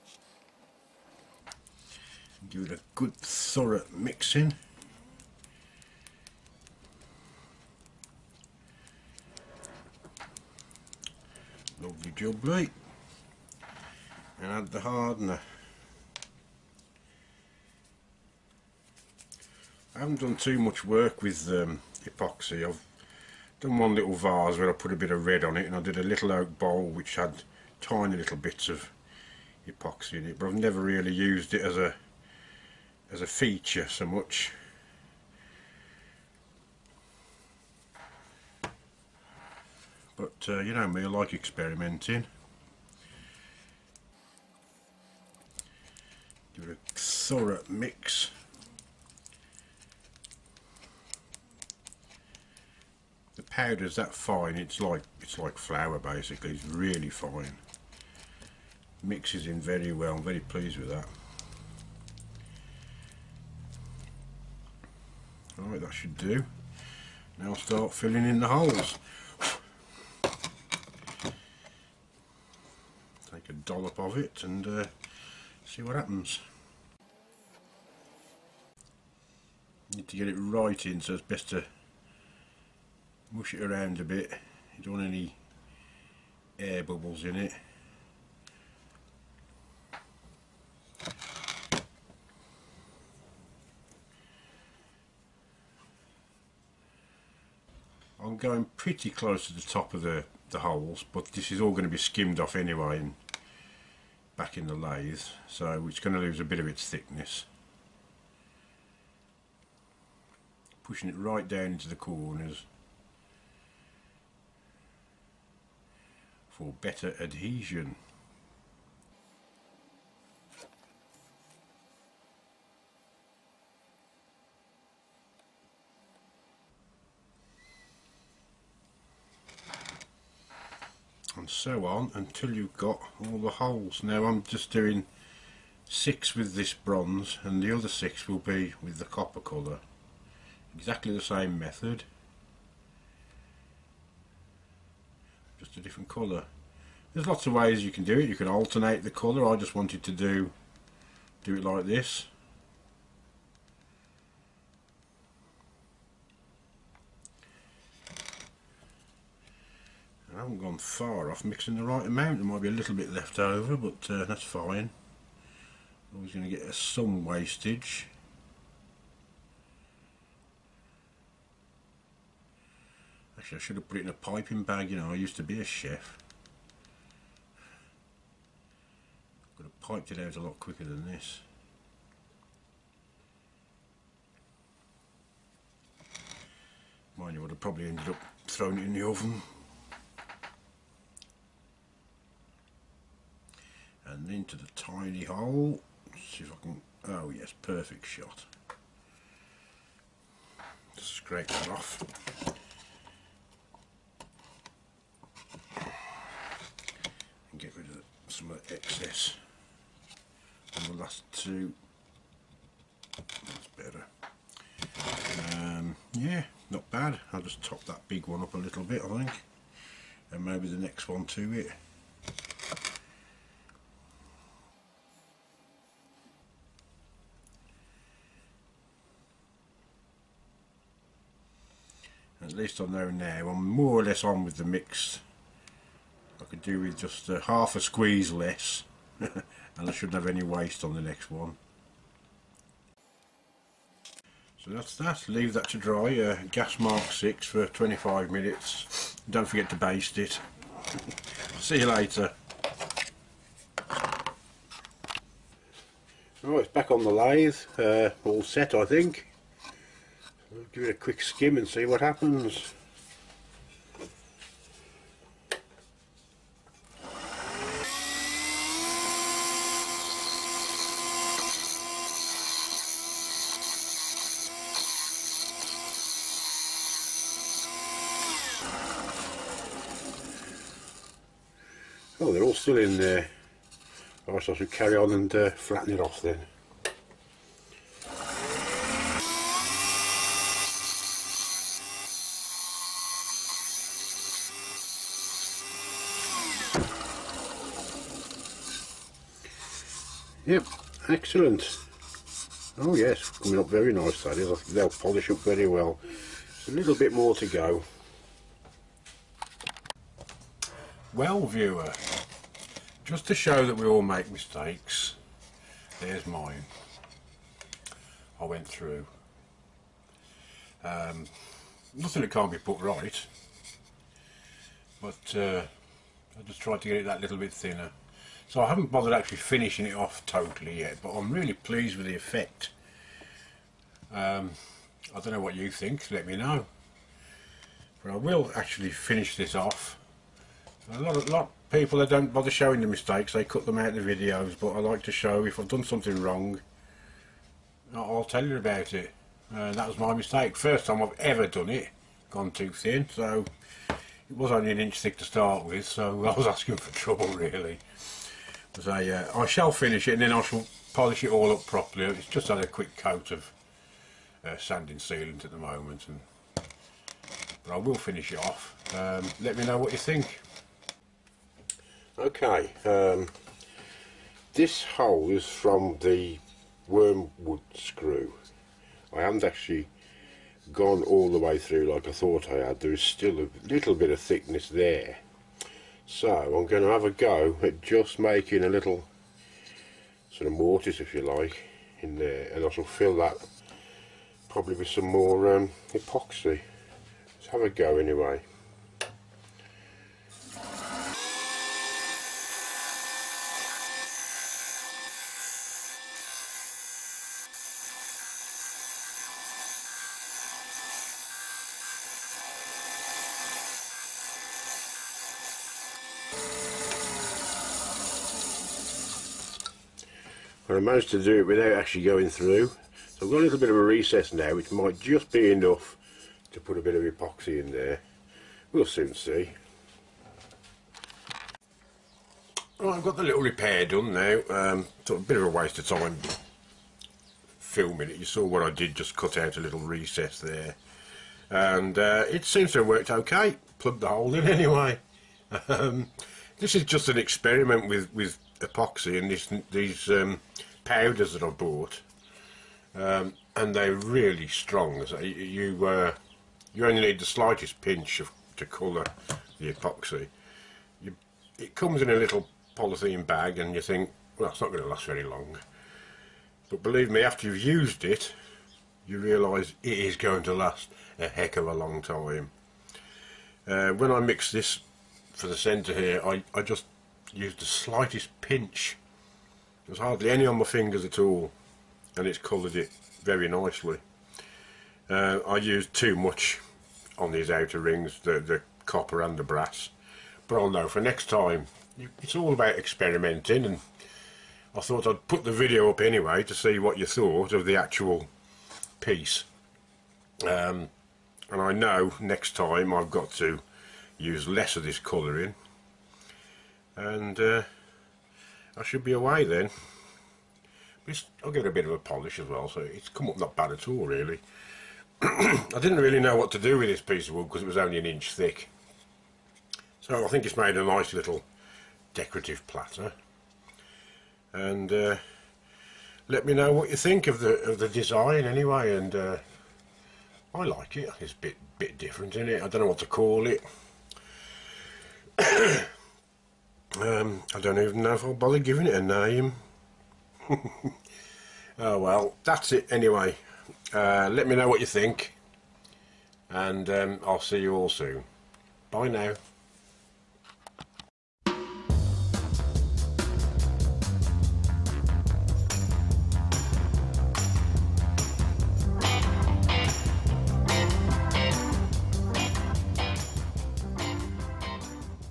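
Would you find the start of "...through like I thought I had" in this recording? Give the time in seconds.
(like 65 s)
381 s.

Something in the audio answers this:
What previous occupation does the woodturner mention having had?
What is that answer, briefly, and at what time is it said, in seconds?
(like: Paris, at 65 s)
chef, at 175 s.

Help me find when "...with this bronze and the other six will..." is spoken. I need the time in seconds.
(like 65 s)
136 s.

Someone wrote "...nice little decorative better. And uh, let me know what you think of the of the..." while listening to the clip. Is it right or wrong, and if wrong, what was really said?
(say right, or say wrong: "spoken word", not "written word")
wrong: "platter", not "better".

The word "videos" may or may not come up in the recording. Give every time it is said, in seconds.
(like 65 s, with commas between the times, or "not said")
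343 s, 495 s.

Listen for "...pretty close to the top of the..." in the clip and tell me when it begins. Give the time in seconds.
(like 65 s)
98 s.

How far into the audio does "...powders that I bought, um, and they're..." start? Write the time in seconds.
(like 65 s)
450 s.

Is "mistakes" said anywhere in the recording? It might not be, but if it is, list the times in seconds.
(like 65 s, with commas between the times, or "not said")
314 s, 342 s, 350 s.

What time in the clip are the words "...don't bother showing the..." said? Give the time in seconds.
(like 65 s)
342 s.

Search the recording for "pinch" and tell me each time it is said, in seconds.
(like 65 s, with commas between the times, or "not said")
457 s, 478 s.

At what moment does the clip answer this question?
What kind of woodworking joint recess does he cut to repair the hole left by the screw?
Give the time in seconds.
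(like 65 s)
390 s.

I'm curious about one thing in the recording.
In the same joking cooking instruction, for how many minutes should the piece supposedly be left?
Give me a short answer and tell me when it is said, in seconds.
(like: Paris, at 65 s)
25 minutes, at 247 s.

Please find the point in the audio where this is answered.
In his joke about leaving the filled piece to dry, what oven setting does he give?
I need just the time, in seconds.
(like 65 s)
246 s.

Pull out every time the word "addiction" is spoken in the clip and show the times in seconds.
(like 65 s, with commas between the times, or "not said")
not said.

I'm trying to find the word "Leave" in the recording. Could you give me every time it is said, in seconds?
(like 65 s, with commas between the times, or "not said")
245 s.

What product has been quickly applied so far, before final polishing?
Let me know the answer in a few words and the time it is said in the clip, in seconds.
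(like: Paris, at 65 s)
sanding sealant, at 364 s.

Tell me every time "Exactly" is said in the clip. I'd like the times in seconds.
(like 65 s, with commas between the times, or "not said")
140 s.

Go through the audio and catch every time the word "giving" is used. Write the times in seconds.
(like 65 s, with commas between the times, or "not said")
538 s.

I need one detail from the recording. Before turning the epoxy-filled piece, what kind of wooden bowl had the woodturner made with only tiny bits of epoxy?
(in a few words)
oak bowl.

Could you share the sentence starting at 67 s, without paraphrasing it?
Now start filling in the holes.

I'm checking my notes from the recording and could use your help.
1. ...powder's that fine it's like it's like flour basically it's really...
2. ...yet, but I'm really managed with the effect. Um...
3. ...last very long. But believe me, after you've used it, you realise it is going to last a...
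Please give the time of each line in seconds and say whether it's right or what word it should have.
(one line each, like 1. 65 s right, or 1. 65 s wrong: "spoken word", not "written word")
1. 53 s right
2. 330 s wrong: "pleased", not "managed"
3. 464 s right.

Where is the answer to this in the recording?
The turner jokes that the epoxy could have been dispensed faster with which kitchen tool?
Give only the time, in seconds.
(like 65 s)
174 s.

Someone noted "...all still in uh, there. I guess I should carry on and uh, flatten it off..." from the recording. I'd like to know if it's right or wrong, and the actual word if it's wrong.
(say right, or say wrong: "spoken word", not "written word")
right.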